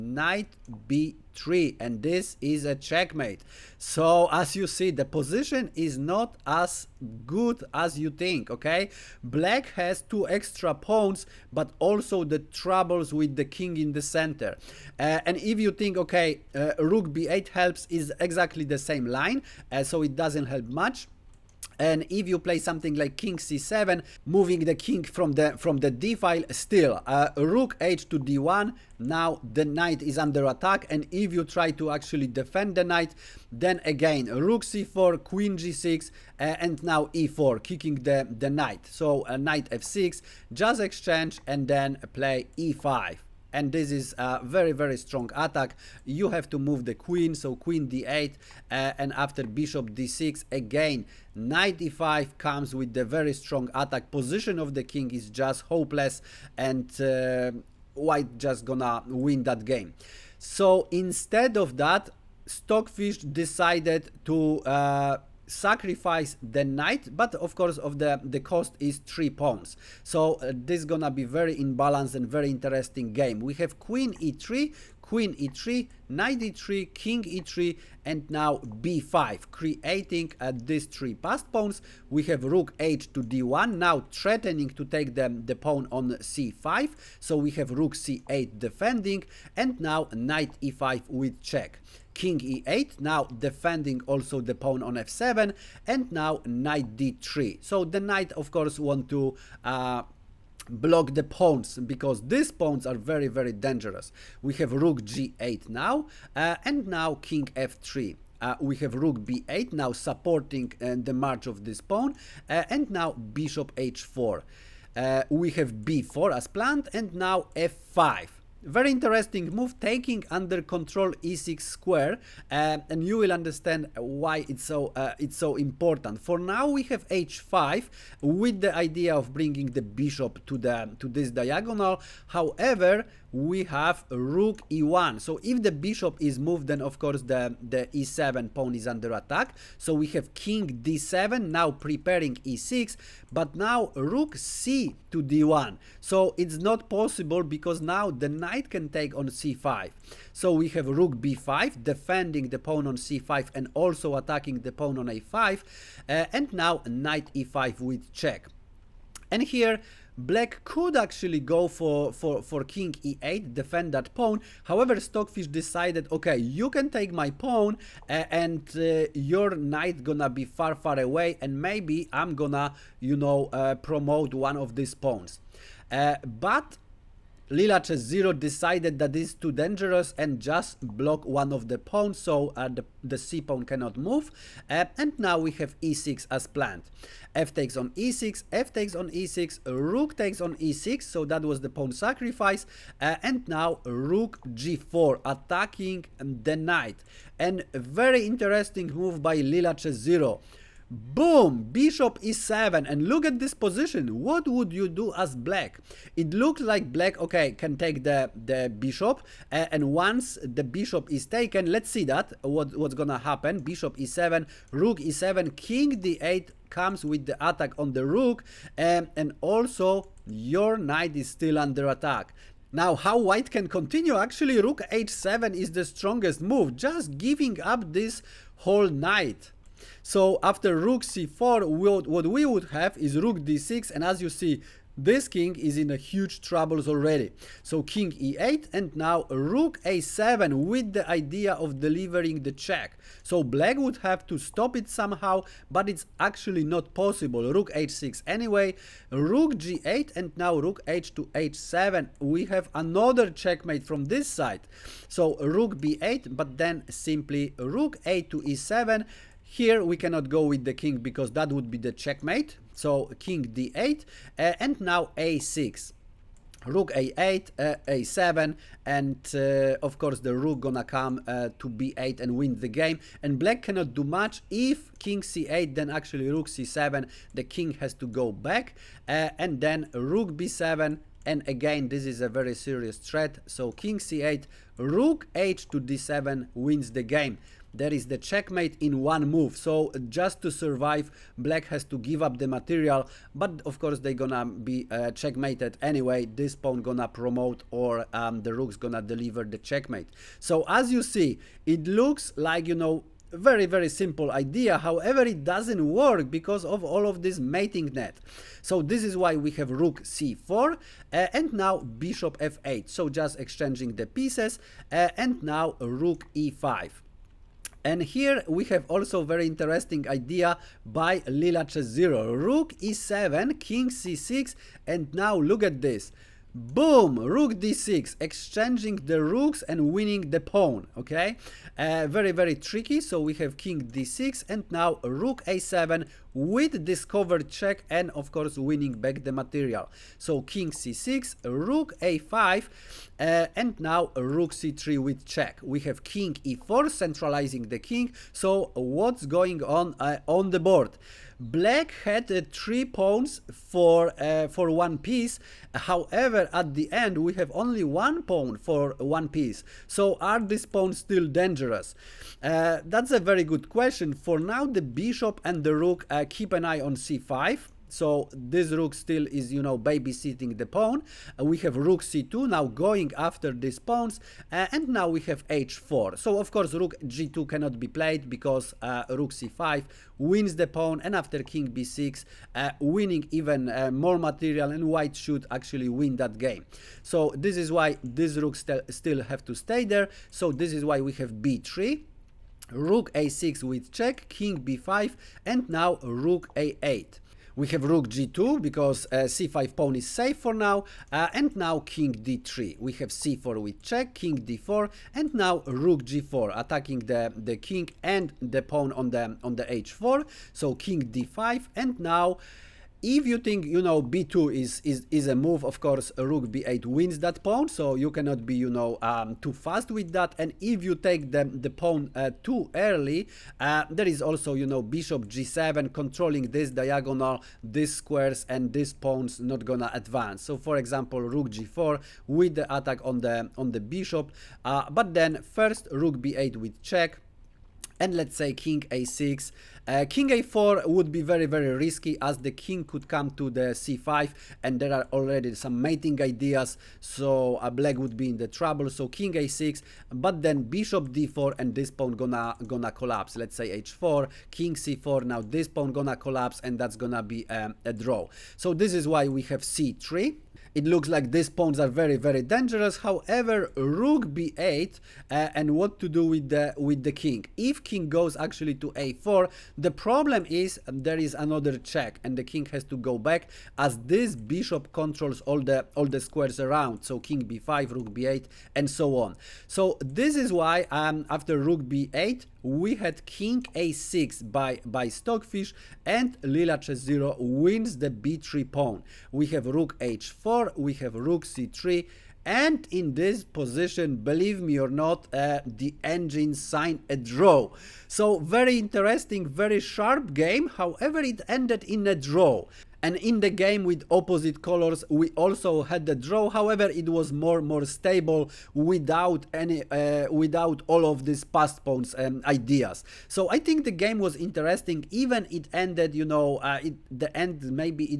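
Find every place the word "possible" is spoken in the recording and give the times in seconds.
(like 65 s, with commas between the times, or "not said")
146 s, 246 s.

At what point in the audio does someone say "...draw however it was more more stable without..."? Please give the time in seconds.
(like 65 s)
506 s.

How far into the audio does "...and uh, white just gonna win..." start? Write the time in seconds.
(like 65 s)
56 s.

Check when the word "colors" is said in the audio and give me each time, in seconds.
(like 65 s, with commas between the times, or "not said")
504 s.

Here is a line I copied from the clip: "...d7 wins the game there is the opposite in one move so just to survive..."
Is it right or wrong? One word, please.
wrong.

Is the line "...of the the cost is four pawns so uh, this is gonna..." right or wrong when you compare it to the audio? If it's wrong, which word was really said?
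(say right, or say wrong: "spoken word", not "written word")
wrong: "three", not "four".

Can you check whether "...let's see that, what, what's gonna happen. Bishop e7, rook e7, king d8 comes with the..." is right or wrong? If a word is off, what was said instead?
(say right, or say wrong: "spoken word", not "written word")
right.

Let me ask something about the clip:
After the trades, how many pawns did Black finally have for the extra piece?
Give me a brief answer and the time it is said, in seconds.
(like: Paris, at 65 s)
1, at 357 s.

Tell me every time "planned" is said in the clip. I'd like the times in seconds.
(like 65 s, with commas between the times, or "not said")
116 s, 186 s.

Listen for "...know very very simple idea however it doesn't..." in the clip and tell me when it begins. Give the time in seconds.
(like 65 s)
302 s.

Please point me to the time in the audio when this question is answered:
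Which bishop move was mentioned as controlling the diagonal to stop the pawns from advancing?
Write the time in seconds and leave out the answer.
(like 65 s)
424 s.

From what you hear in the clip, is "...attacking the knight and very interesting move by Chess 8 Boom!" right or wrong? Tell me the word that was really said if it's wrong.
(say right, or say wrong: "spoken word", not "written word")
wrong: "0", not "8".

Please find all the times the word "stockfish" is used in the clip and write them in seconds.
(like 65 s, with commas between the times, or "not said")
62 s, 164 s, 485 s.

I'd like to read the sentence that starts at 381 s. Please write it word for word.
And after king b6, uh, winning even uh, more material and white should actually win that game.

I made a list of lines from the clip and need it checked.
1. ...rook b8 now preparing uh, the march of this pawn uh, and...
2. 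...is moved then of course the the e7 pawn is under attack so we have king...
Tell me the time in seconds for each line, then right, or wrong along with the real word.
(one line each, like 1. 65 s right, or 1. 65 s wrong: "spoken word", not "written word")
1. 108 s wrong: "supporting", not "preparing"
2. 136 s right.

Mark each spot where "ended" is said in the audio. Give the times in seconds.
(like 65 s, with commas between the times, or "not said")
501 s, 515 s.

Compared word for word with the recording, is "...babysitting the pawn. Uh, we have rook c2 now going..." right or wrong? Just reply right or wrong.
right.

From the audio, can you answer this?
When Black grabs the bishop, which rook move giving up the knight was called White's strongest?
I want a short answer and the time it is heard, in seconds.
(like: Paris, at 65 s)
Rook h7, at 224 s.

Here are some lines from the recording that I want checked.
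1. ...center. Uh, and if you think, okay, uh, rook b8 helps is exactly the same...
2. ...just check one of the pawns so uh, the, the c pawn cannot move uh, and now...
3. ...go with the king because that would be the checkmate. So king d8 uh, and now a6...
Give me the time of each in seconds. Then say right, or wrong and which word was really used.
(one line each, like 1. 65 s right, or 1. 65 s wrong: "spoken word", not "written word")
1. 14 s right
2. 180 s wrong: "block", not "check"
3. 260 s right.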